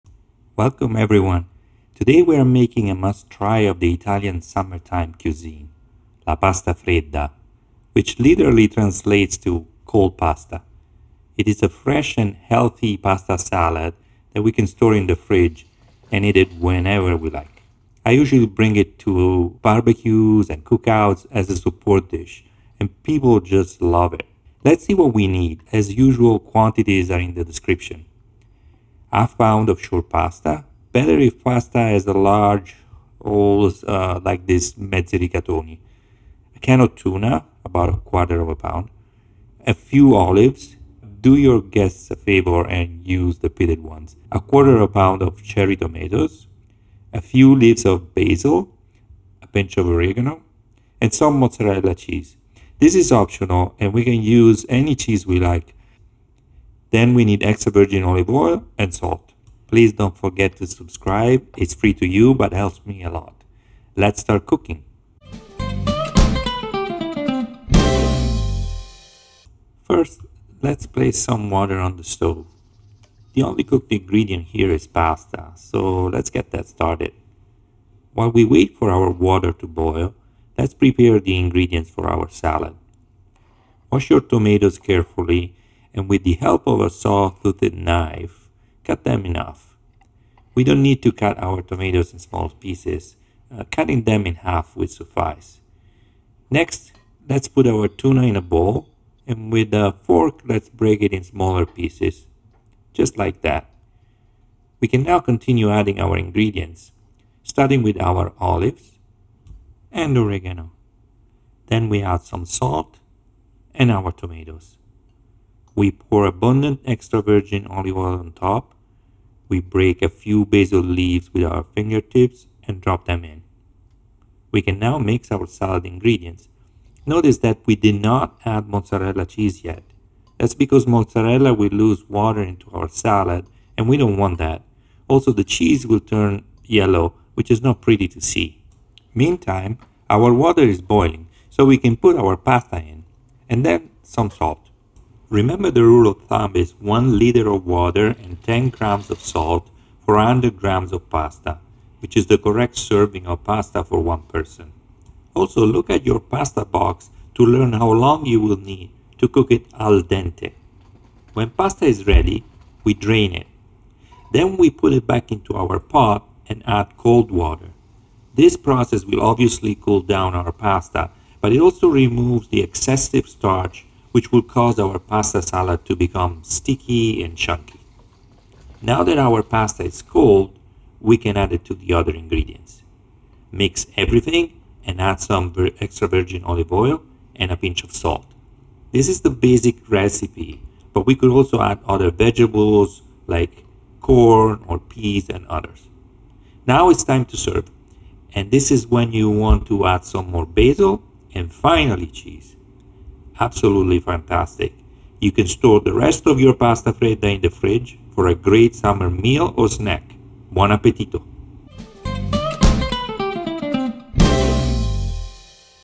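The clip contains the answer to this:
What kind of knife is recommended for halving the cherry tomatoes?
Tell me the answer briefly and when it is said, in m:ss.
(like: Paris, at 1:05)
saw-toothed knife, at 1:26.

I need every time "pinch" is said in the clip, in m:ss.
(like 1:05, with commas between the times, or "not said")
0:49, 3:07.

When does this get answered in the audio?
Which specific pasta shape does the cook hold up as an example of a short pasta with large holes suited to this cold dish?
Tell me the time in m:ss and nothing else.
0:34.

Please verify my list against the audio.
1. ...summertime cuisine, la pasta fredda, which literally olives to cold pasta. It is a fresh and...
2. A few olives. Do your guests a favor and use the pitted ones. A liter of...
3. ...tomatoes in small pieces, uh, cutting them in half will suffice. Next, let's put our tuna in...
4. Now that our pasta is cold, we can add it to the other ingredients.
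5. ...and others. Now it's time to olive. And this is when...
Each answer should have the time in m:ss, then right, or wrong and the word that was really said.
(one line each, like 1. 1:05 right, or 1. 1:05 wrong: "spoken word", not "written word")
1. 0:04 wrong: "translates", not "olives"
2. 0:39 wrong: "quarter", not "liter"
3. 1:31 right
4. 2:58 right
5. 3:15 wrong: "serve", not "olive".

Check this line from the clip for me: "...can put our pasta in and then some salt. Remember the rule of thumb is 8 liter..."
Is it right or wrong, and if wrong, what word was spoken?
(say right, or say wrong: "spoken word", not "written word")
wrong: "1", not "8".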